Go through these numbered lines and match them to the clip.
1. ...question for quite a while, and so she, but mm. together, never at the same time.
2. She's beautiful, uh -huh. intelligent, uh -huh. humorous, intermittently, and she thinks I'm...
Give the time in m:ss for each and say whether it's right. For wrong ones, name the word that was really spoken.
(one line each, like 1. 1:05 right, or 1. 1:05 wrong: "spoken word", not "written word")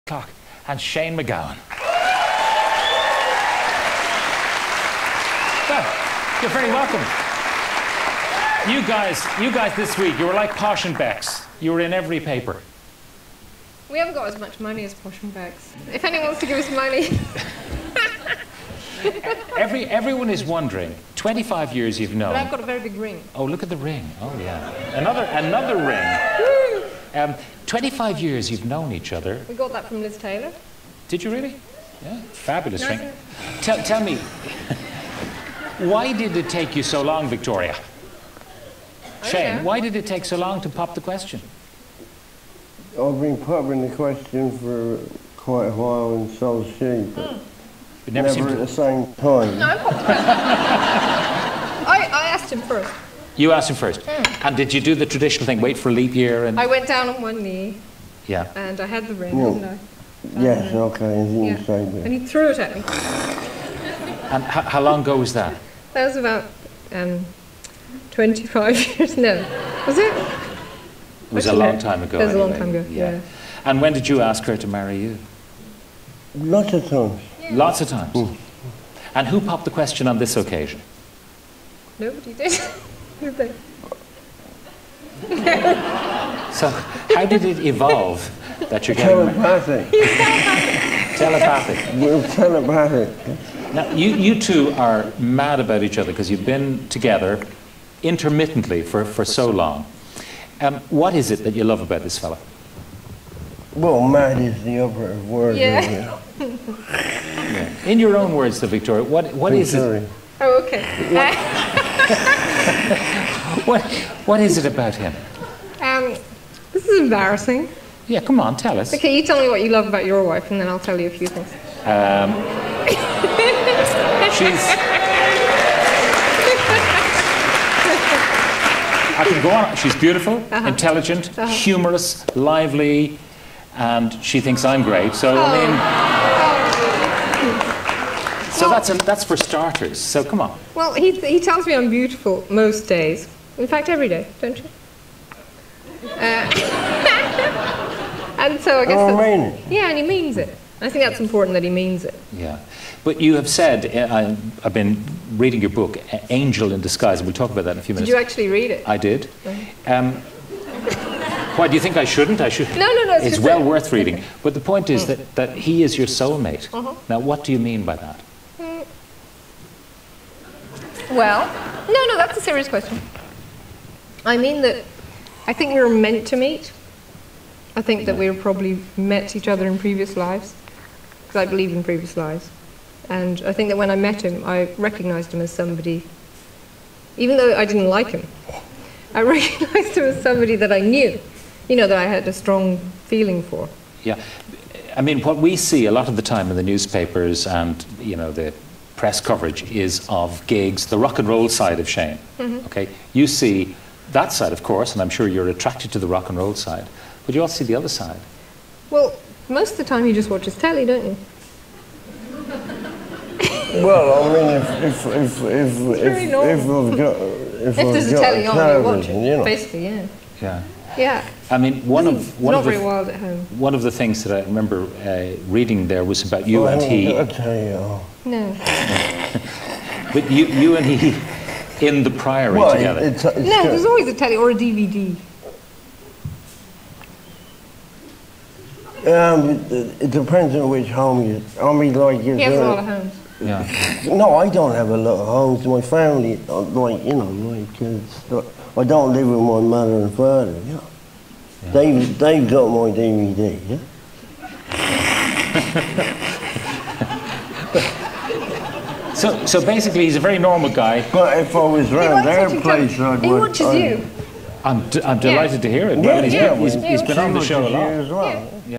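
1. 0:43 wrong: "never", not "together"
2. 2:09 wrong: "lively", not "intermittently".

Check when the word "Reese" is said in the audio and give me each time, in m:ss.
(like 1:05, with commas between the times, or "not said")
not said.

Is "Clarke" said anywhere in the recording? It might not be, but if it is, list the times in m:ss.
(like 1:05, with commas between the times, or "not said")
0:00.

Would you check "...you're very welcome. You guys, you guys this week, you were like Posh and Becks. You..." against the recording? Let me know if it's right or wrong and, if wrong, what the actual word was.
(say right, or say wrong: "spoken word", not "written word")
right.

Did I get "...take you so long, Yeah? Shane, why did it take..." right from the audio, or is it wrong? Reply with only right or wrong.
wrong.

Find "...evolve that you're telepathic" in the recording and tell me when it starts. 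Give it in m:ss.
1:27.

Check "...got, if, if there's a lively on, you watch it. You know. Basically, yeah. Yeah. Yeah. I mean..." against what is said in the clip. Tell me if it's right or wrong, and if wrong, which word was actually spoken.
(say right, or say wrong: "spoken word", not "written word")
wrong: "telly", not "lively".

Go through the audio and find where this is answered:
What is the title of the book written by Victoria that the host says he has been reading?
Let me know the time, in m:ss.
2:36.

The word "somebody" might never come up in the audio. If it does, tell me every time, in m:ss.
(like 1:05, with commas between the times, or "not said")
3:05, 3:10.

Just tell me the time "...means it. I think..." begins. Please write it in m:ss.
2:30.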